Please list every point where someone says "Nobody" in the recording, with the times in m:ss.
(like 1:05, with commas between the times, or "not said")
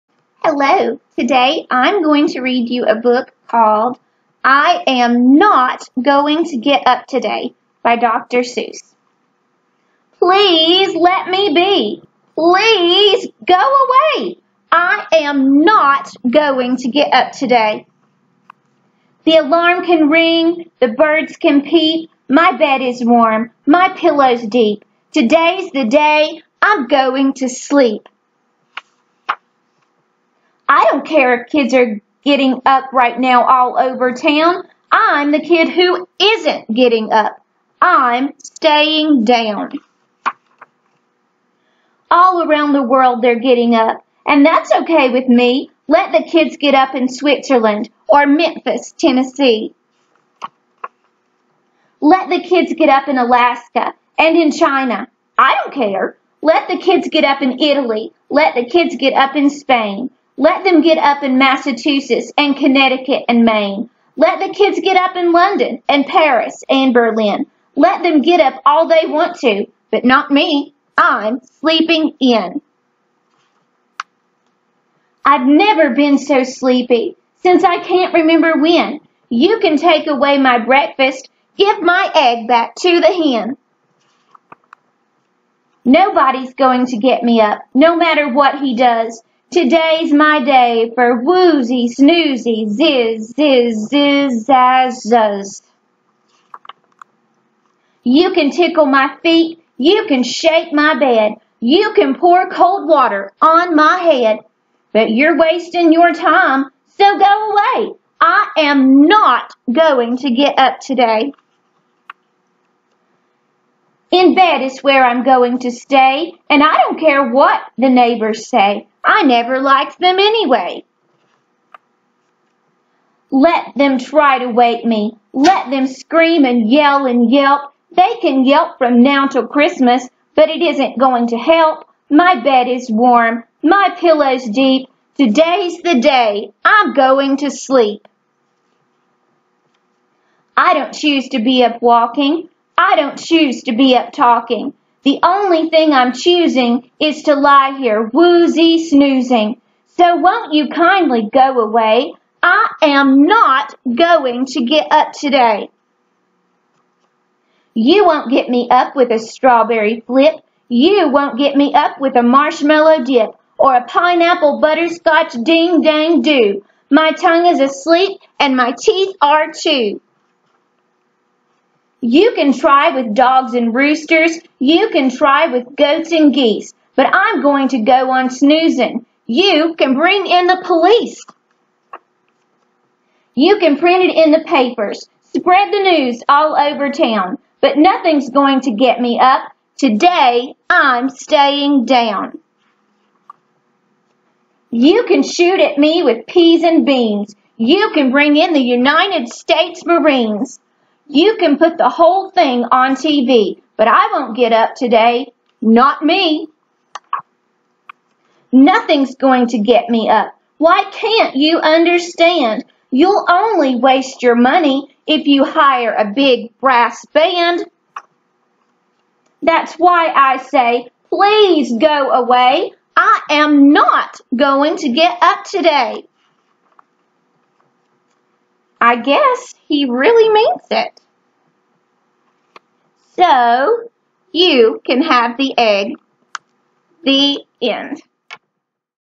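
1:25.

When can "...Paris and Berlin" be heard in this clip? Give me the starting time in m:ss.
1:06.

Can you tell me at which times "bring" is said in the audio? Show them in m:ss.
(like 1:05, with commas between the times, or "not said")
2:59, 3:18.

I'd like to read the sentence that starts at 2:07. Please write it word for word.
They can yelp from now till Christmas, but it isn't going to help.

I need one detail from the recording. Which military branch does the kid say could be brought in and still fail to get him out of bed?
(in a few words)
United States Marines.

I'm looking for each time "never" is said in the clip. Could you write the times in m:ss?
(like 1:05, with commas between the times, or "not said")
1:15, 1:59.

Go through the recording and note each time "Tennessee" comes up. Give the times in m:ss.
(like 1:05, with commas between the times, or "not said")
0:48.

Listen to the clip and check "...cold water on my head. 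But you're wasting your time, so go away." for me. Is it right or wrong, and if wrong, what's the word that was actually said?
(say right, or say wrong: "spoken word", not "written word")
right.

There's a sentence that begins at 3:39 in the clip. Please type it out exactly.
That's why I say, please go away.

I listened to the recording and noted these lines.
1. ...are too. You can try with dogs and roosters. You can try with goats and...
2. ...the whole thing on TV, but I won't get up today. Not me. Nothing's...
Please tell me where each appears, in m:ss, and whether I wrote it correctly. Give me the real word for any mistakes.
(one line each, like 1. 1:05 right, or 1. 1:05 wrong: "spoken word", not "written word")
1. 2:49 right
2. 3:21 right.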